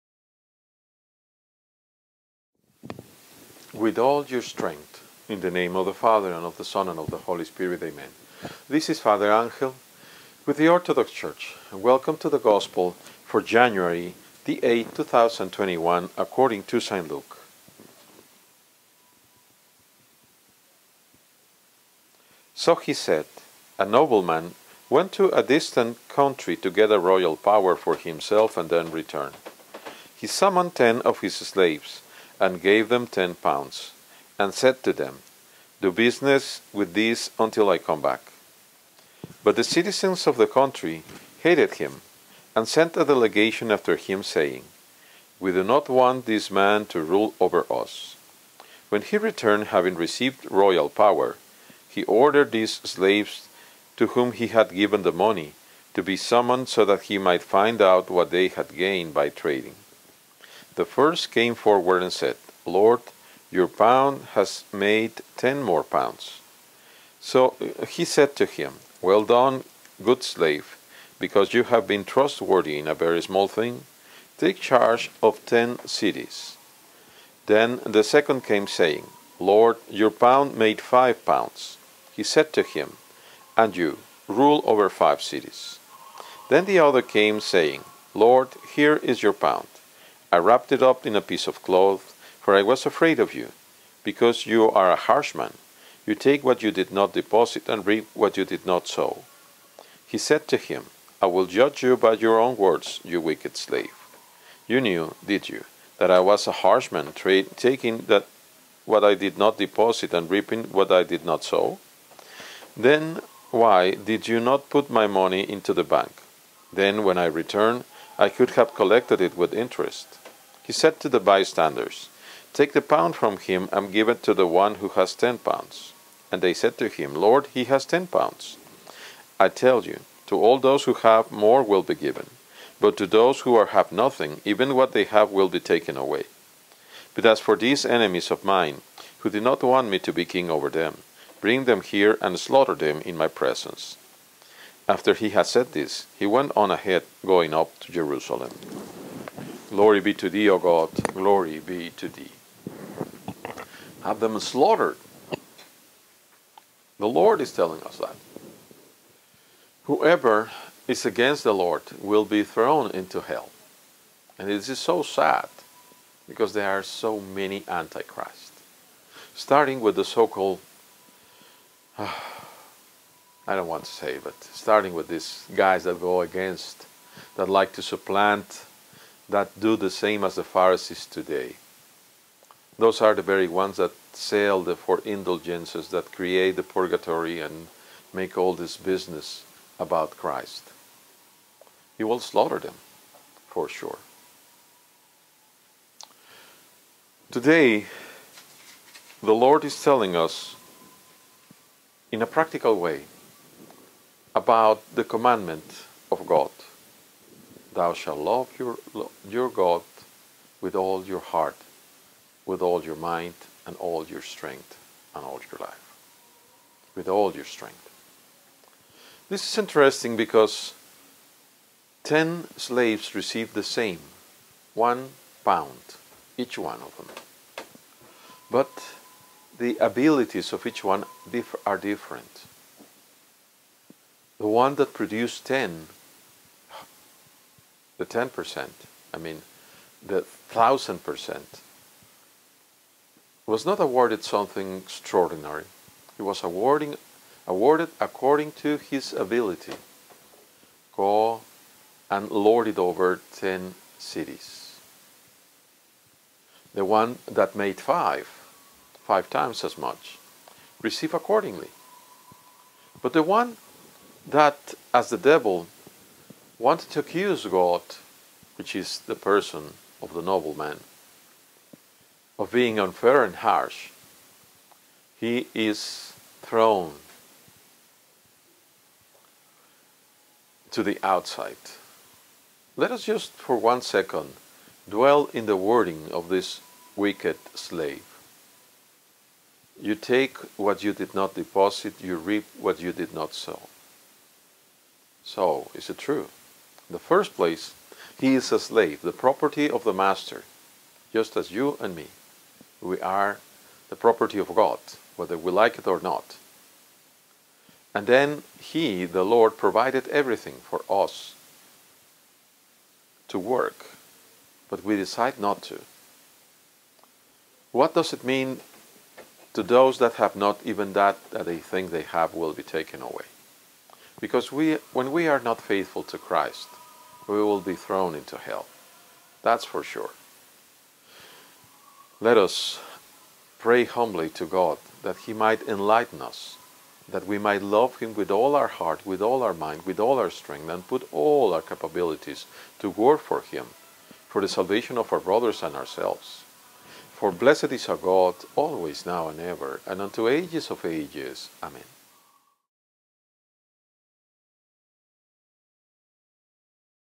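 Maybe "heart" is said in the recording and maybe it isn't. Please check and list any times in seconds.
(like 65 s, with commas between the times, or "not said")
211 s, 338 s.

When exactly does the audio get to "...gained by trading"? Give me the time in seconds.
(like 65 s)
58 s.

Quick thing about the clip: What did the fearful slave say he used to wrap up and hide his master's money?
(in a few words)
A piece of cloth.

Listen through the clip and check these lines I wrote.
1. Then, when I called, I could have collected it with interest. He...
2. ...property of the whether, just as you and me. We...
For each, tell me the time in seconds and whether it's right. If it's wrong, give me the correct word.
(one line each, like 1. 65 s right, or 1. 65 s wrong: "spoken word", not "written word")
1. 116 s wrong: "returned", not "called"
2. 299 s wrong: "master", not "whether".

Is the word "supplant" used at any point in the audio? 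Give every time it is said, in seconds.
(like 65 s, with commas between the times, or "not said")
177 s.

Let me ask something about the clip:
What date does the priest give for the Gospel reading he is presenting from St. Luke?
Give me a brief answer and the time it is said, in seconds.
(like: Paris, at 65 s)
January 8th, 2021, at 13 s.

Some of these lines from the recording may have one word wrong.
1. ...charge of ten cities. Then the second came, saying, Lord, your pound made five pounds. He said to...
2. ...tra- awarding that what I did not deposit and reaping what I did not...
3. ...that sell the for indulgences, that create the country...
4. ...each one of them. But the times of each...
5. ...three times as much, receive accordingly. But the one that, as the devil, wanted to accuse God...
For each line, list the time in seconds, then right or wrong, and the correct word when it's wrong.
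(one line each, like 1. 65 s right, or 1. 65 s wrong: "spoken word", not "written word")
1. 74 s right
2. 107 s wrong: "taking", not "awarding"
3. 183 s wrong: "purgatory", not "country"
4. 226 s wrong: "abilities", not "times"
5. 259 s wrong: "five", not "three".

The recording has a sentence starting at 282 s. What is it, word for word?
Let us just for one second dwell in the wording of this wicked slave.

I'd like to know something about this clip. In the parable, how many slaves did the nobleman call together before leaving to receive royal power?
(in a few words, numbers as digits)
10.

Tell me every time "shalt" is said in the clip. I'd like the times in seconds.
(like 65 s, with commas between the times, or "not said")
207 s.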